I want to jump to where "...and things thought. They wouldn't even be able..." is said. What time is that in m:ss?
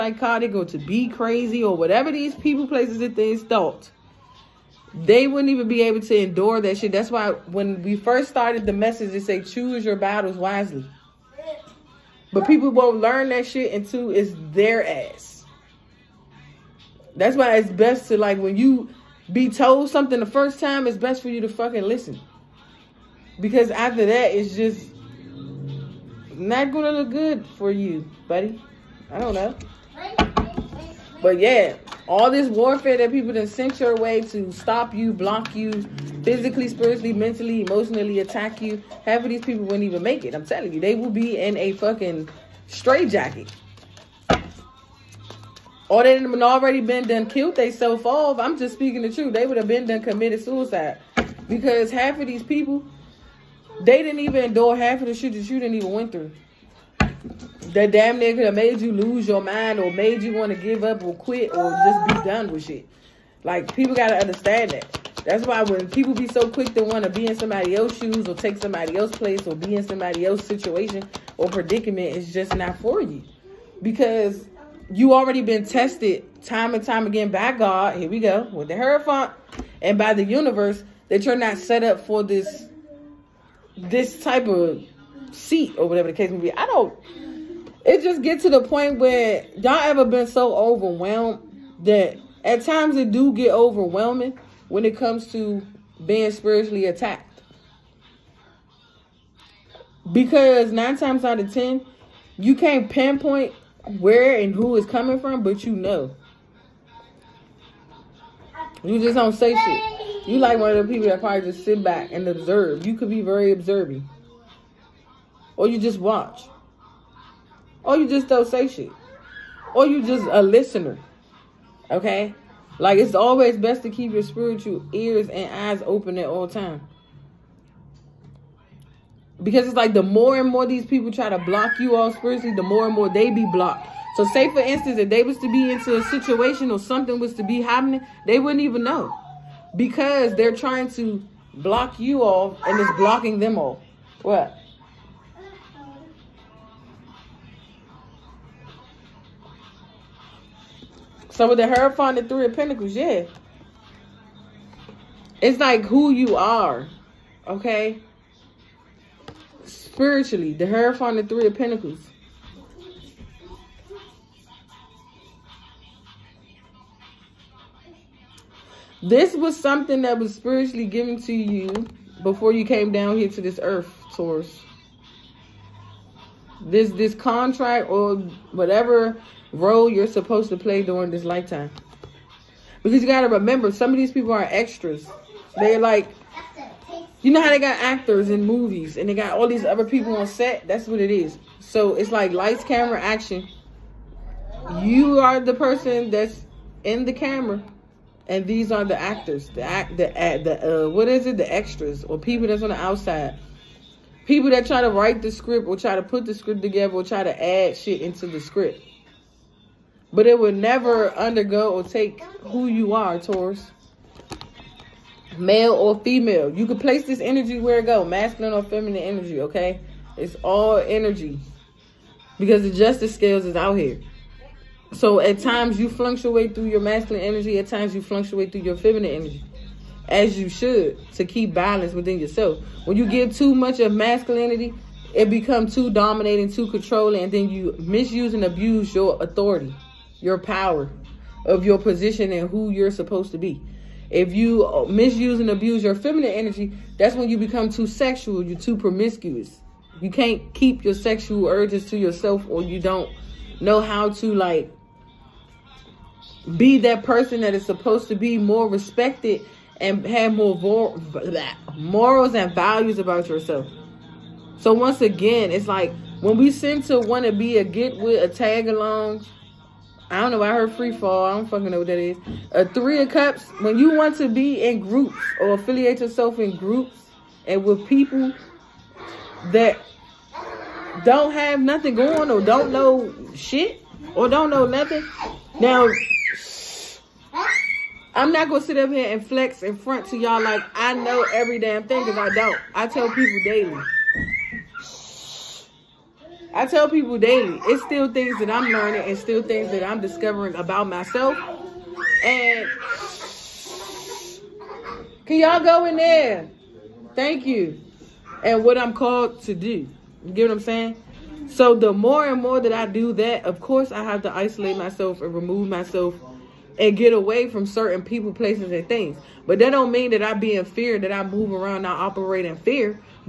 0:03.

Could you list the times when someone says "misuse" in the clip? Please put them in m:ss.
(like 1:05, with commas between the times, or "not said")
3:57, 4:04.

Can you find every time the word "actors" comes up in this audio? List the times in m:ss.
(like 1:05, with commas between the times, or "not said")
3:07, 3:18.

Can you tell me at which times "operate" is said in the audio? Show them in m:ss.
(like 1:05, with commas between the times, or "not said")
5:21.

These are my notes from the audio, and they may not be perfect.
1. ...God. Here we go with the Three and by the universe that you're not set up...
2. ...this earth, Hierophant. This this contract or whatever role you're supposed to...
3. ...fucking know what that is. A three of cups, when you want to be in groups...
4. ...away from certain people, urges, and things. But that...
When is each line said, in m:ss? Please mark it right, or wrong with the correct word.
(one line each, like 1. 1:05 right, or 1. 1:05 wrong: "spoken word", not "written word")
1. 1:17 wrong: "Hierophant", not "Three"
2. 2:53 wrong: "Taurus", not "Hierophant"
3. 4:31 right
4. 5:17 wrong: "places", not "urges".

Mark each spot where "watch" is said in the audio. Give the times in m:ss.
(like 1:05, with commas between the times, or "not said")
1:55.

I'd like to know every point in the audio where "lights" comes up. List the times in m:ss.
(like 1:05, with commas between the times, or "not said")
3:12.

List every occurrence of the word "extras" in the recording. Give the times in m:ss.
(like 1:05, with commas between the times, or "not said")
3:04, 3:21.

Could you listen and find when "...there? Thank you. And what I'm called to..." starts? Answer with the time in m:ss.
5:05.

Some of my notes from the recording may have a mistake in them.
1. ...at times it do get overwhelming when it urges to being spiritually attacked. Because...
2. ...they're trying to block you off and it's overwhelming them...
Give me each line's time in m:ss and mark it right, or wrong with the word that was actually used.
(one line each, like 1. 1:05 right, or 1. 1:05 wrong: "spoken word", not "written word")
1. 1:32 wrong: "comes", not "urges"
2. 2:20 wrong: "blocking", not "overwhelming".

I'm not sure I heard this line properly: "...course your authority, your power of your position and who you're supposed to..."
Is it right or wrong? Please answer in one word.
wrong.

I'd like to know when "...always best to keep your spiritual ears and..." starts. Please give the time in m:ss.
2:03.